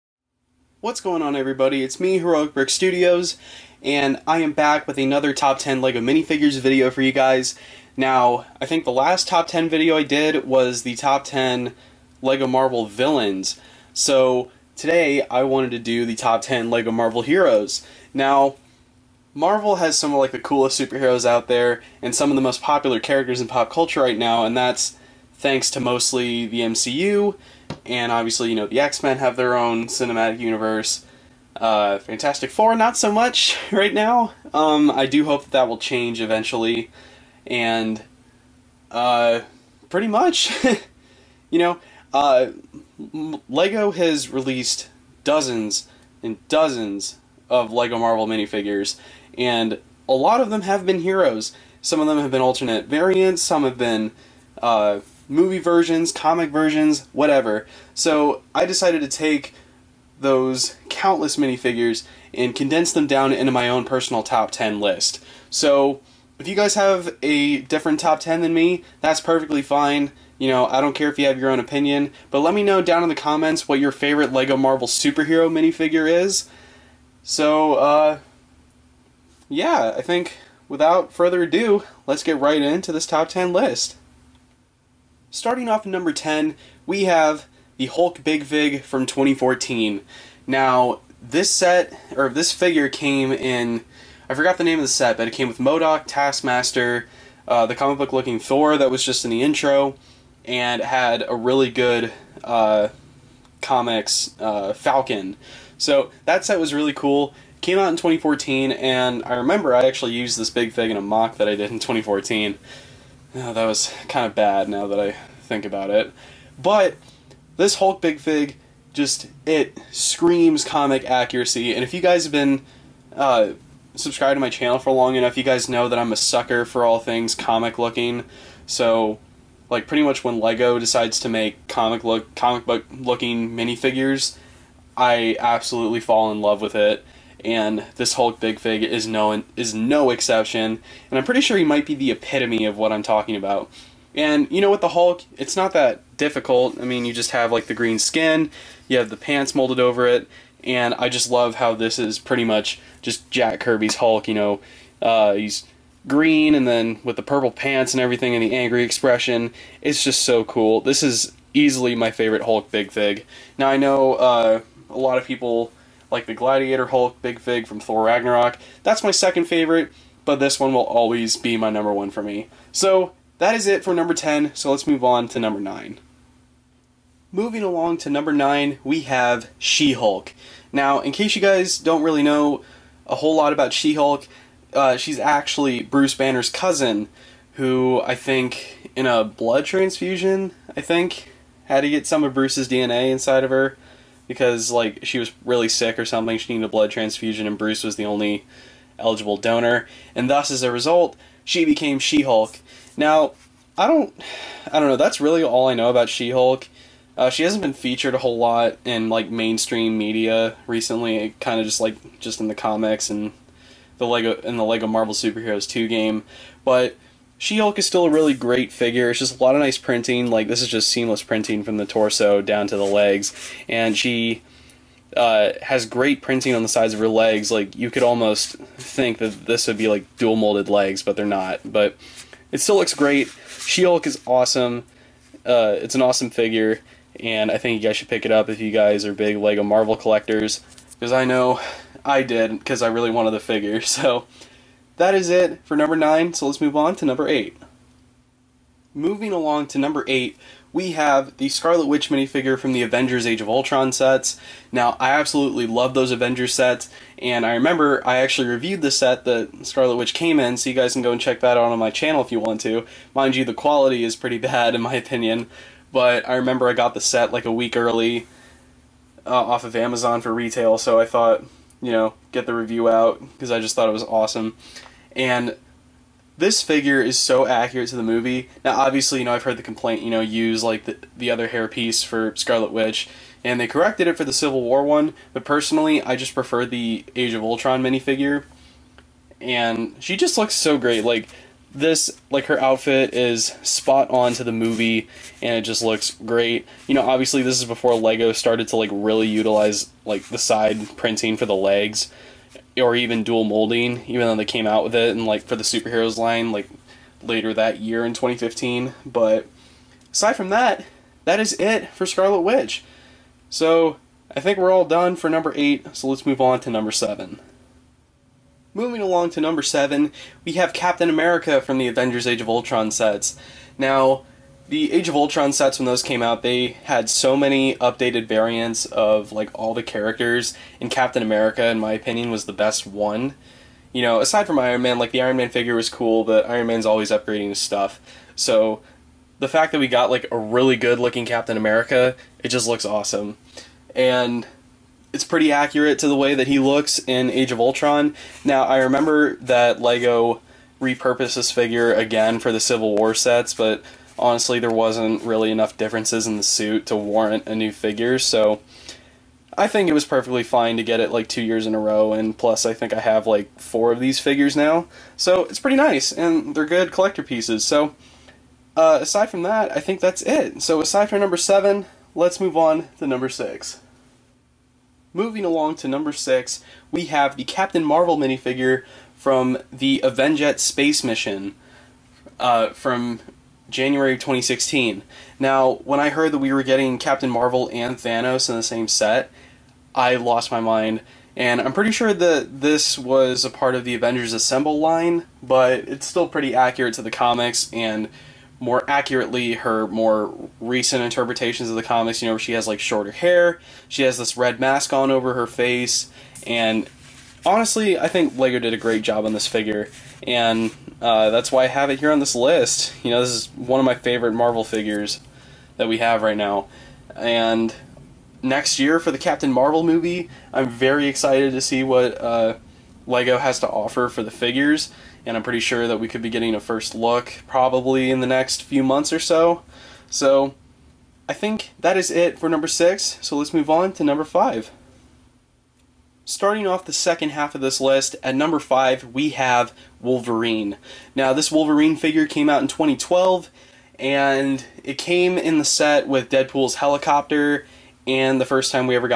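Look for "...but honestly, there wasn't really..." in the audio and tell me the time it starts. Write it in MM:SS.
05:53.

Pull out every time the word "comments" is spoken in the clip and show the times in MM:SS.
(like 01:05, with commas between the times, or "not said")
01:13.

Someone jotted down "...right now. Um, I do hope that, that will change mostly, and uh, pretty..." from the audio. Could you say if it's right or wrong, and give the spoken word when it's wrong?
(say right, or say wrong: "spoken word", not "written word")
wrong: "eventually", not "mostly".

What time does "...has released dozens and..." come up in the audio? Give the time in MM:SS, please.
00:43.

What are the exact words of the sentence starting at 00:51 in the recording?
Some of them have been alternate variants.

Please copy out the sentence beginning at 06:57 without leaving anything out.
And next year for the Captain Marvel movie, I'm very excited to see what uh, LEGO has to offer for the figures.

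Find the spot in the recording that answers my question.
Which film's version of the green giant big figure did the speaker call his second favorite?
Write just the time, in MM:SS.
02:47.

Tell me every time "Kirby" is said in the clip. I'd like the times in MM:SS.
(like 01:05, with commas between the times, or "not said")
02:33.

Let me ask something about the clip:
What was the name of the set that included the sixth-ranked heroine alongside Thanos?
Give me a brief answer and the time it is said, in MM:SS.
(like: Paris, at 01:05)
Avenjet space mission, at 06:20.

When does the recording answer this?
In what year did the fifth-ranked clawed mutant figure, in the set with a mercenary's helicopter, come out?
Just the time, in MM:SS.
07:22.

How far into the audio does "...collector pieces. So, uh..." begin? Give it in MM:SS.
06:06.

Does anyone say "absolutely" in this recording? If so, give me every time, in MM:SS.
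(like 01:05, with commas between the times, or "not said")
02:15, 04:15.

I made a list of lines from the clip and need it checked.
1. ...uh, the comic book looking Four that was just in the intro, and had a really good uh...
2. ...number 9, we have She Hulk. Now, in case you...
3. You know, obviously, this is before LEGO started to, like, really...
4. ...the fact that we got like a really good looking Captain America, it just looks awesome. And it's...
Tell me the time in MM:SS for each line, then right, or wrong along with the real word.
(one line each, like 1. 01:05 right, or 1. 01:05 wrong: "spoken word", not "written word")
1. 01:37 wrong: "Thor", not "Four"
2. 02:58 right
3. 04:56 right
4. 05:39 right.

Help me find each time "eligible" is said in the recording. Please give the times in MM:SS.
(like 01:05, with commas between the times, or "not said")
03:18.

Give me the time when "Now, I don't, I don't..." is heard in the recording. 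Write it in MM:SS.
03:22.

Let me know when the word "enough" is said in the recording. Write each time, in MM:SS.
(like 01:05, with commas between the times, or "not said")
02:05, 05:55.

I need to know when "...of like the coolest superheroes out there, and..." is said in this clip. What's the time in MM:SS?
00:20.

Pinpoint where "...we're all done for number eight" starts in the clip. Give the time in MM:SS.
05:14.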